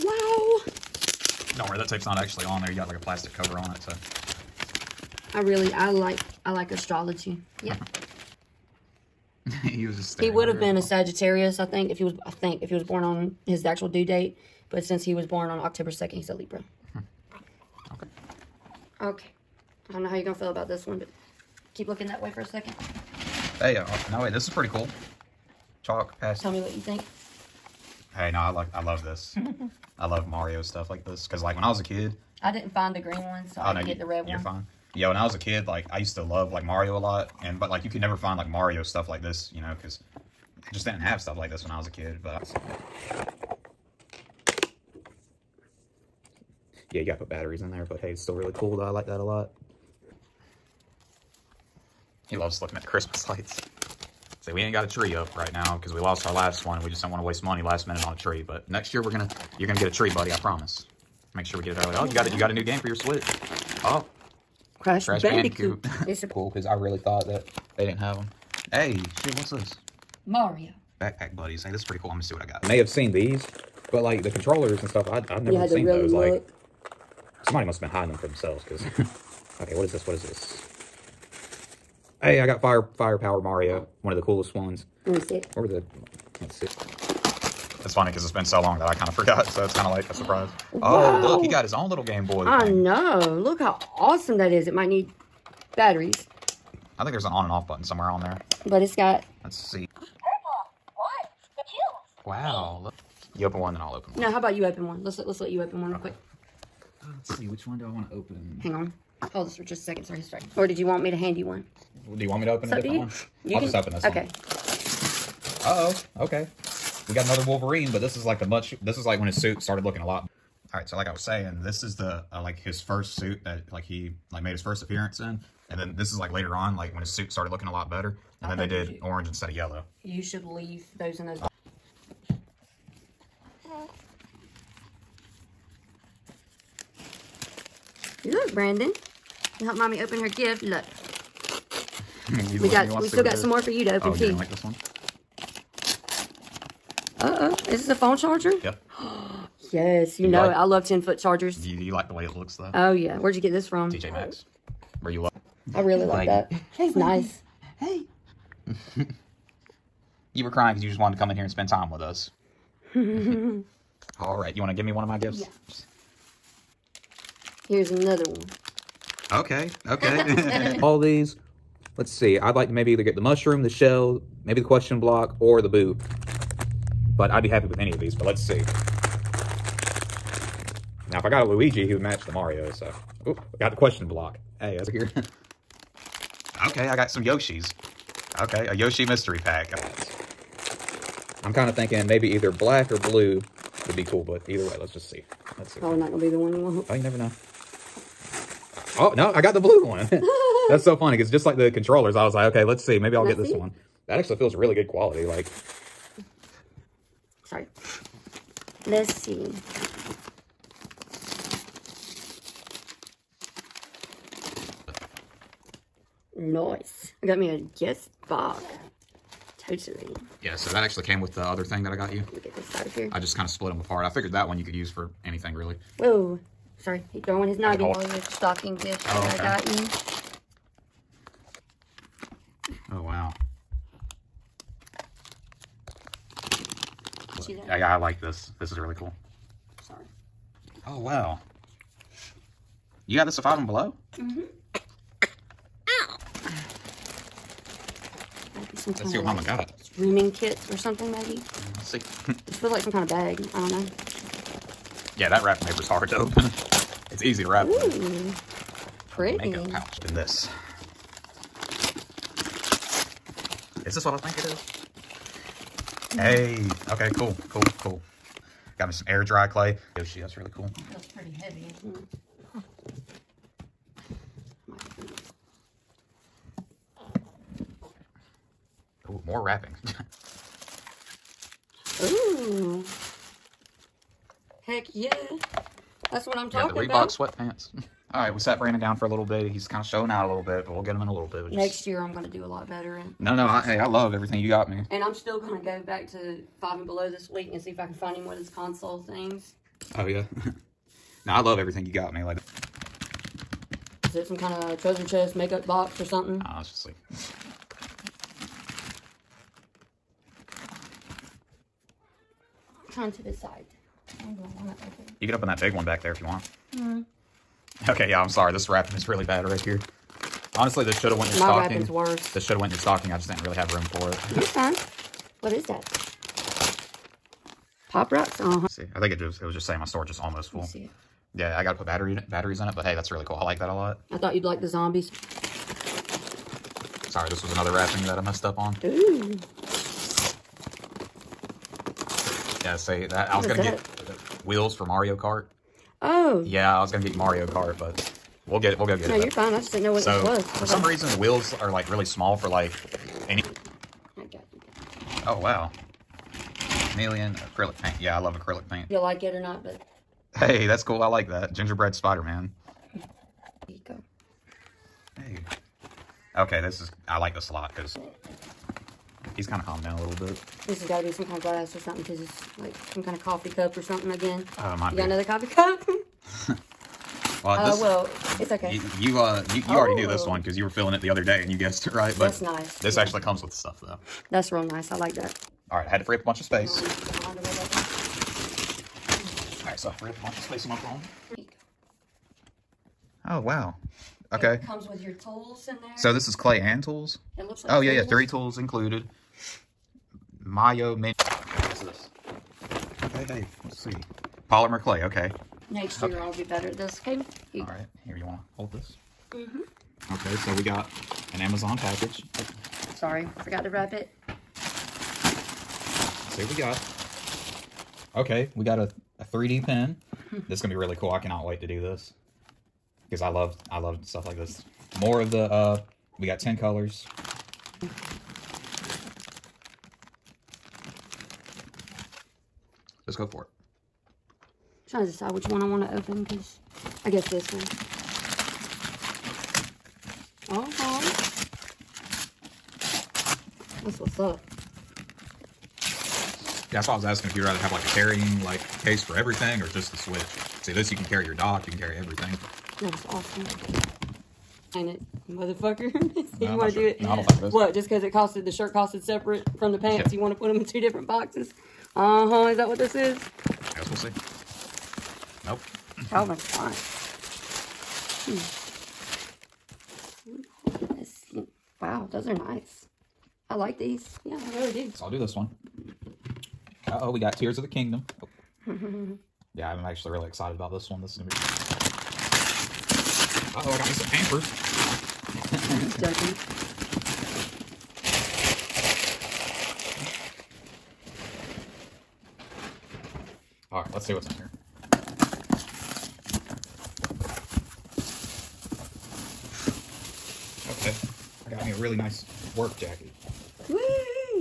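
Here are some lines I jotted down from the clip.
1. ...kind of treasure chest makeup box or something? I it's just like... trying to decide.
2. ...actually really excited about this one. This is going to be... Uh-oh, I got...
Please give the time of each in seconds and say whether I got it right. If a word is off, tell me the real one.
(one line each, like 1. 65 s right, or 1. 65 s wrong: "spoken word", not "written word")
1. 304 s right
2. 479 s right.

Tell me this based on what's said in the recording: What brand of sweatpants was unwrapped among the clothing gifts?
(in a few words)
Reebok.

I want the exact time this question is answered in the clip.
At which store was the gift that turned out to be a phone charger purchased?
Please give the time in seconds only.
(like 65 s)
153 s.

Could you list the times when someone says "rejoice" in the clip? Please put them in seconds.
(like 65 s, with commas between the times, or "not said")
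not said.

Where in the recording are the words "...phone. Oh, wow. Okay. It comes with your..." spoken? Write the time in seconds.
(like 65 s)
390 s.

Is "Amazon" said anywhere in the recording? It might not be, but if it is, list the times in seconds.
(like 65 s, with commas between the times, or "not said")
411 s.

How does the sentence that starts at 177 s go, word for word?
But I'd be happy with any of these, but let's see.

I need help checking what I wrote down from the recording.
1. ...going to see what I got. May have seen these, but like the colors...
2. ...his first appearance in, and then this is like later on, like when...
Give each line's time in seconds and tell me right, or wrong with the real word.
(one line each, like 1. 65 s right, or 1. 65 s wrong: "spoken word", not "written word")
1. 72 s wrong: "controllers", not "colors"
2. 124 s right.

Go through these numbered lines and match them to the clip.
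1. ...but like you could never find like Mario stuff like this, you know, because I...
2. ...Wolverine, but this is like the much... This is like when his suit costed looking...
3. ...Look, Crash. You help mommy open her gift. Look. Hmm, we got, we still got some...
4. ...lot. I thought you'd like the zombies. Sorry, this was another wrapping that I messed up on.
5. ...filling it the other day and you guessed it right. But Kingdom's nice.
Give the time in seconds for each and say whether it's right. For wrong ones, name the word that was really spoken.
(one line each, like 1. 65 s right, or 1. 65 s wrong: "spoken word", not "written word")
1. 37 s right
2. 117 s wrong: "started", not "costed"
3. 138 s wrong: "Brandon", not "Crash"
4. 333 s right
5. 380 s wrong: "That", not "Kingdom".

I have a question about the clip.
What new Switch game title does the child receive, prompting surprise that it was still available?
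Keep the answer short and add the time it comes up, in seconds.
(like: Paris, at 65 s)
Crash Bandicoot, at 65 s.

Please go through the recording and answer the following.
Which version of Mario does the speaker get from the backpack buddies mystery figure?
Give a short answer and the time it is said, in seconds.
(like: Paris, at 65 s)
Fire Firepower Mario, at 82 s.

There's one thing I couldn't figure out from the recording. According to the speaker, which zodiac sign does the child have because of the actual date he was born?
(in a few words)
Libra.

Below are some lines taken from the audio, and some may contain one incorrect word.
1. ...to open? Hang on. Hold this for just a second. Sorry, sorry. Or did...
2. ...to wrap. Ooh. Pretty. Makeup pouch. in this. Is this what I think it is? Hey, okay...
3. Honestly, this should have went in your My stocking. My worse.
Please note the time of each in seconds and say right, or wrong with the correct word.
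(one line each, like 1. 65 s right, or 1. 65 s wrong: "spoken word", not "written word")
1. 108 s right
2. 257 s right
3. 320 s right.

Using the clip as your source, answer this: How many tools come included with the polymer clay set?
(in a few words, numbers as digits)
3.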